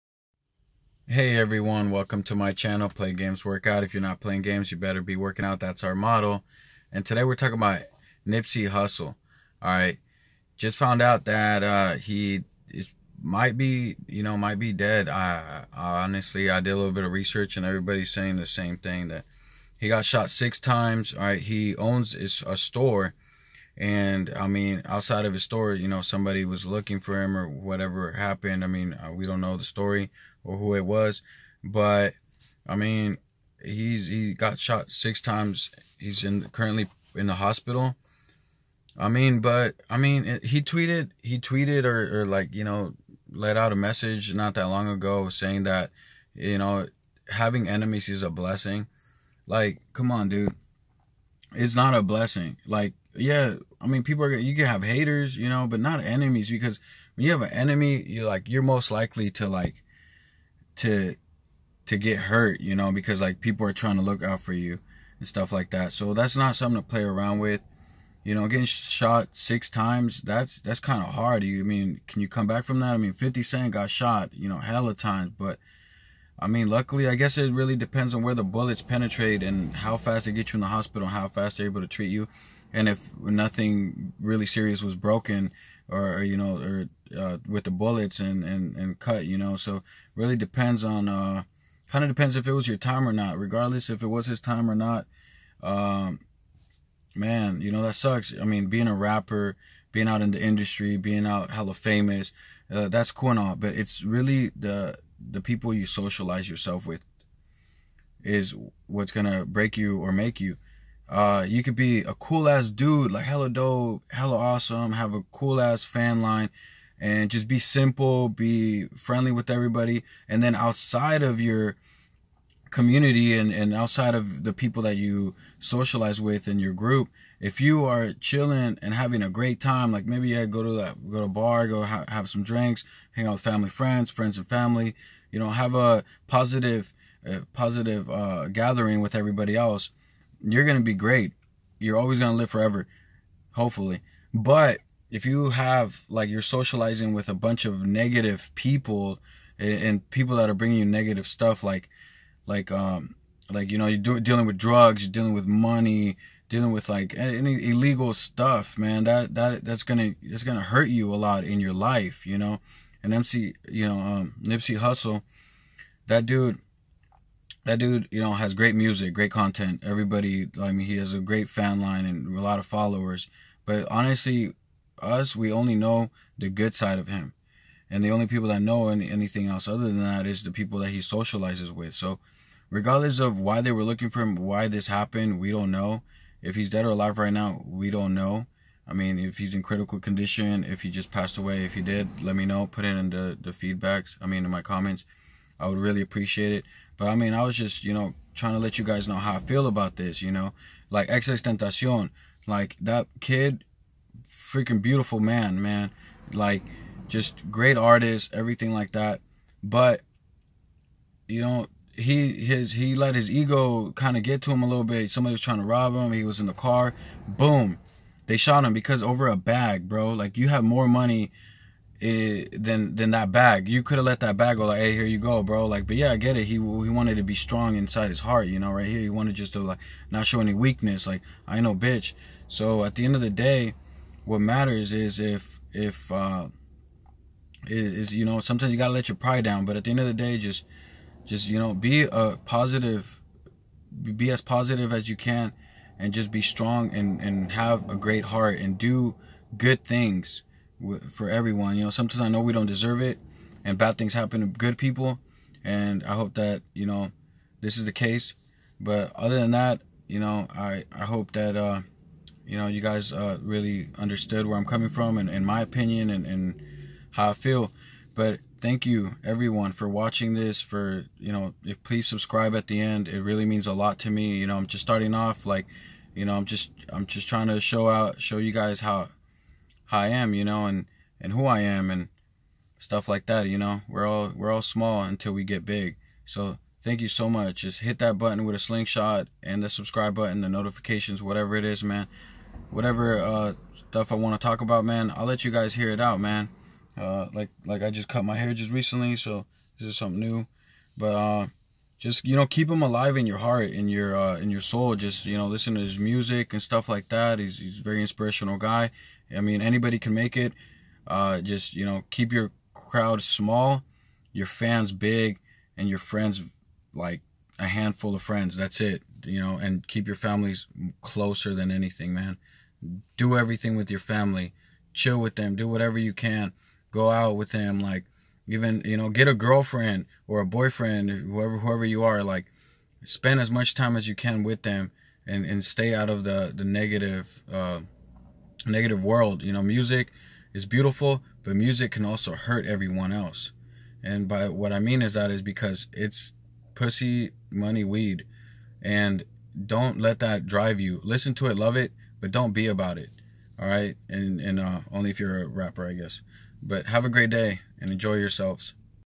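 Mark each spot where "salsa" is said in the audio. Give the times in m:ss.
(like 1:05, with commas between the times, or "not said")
not said.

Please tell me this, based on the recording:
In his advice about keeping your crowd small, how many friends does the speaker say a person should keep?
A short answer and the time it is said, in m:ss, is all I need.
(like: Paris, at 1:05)
a handful, at 5:17.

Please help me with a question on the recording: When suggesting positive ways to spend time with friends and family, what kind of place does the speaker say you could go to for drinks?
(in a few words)
a bar.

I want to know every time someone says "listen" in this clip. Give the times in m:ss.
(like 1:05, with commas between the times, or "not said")
5:05, 5:51.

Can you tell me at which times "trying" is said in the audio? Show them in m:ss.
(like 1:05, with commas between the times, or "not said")
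1:03, 3:18, 3:35, 4:37.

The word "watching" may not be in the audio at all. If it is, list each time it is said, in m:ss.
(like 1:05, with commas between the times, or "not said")
4:29.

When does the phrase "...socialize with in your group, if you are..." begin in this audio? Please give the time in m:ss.
2:05.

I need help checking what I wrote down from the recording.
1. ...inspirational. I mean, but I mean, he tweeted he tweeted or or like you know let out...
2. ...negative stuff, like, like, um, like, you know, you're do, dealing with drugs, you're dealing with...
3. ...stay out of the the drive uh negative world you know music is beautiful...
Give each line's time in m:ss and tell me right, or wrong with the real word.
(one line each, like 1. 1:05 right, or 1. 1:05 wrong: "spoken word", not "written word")
1. 0:37 wrong: "hospital", not "inspirational"
2. 2:30 right
3. 5:35 wrong: "negative", not "drive".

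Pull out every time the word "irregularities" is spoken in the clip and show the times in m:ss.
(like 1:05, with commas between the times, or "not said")
not said.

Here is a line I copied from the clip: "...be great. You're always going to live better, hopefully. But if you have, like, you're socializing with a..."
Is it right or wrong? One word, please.
wrong.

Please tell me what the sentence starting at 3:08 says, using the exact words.
I mean, if he's in critical condition, if he just passed away, if he did, let me know.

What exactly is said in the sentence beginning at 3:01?
So, regardless of why they were looking for him, why this happened, we don't know.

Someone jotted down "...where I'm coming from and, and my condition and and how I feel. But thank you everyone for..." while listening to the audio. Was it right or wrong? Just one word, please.
wrong.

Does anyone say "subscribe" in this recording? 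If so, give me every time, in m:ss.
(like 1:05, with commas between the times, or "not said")
4:32, 4:49.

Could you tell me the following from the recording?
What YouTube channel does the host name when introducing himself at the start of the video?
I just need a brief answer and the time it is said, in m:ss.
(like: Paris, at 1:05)
Play Games Workout, at 0:02.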